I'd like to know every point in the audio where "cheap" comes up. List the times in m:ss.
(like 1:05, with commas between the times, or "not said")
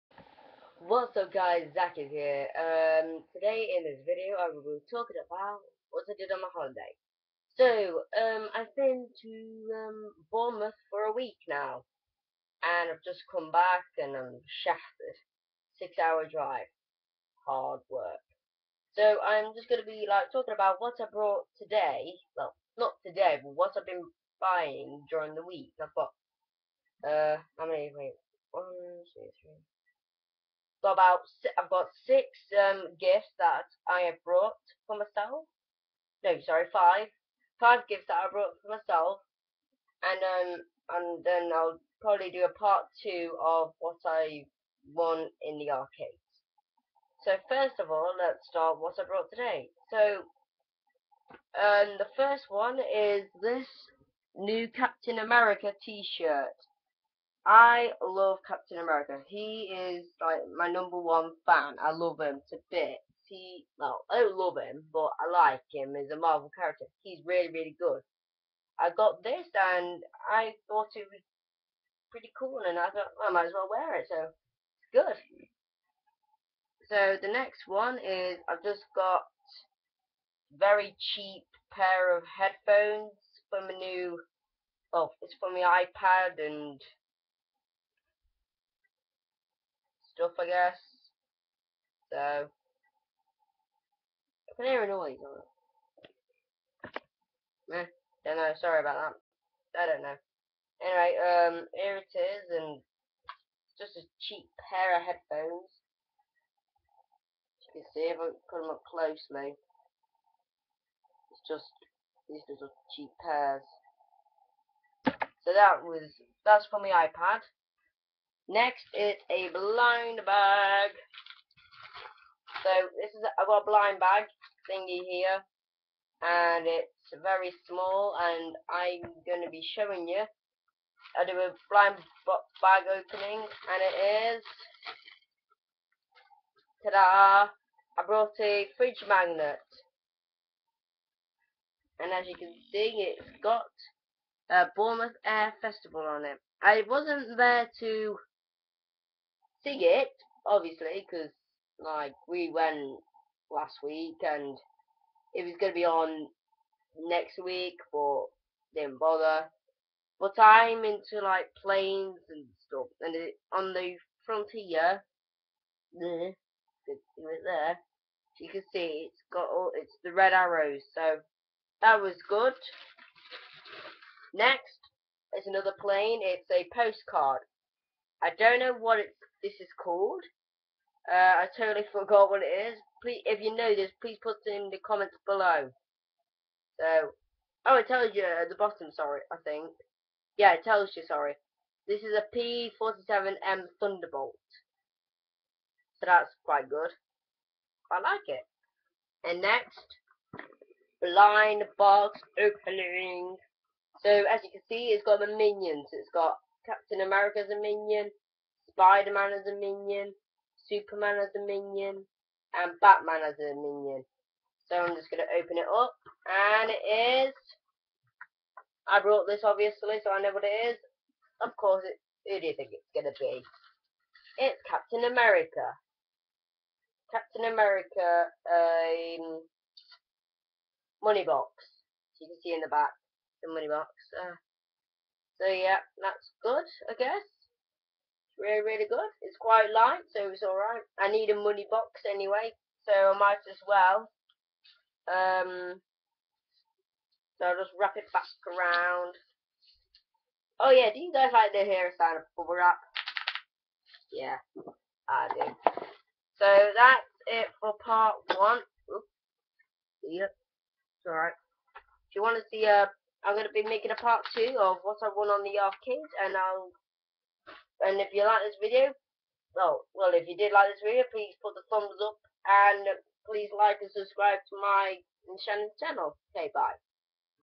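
1:21, 1:44, 1:52.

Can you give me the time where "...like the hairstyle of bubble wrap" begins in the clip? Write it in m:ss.
4:11.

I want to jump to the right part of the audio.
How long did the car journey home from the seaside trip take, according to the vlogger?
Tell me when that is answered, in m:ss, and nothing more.
0:15.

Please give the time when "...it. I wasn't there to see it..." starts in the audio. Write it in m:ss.
2:26.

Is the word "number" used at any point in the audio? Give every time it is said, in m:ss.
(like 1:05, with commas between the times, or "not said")
1:00.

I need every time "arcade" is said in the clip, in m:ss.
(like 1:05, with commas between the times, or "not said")
0:45, 4:25.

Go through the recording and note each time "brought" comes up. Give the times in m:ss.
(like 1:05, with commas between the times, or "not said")
0:21, 0:34, 0:38, 0:49, 2:18, 3:39.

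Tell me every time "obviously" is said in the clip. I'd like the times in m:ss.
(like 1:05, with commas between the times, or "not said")
2:30, 3:39.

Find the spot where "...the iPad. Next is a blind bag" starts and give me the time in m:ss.
1:56.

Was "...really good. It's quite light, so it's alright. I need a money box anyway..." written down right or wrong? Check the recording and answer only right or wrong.
right.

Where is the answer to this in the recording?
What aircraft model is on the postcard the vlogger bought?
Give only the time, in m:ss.
3:12.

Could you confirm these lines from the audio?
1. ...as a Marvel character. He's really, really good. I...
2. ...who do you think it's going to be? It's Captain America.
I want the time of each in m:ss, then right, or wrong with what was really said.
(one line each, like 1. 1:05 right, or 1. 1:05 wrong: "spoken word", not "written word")
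1. 1:05 right
2. 3:42 right.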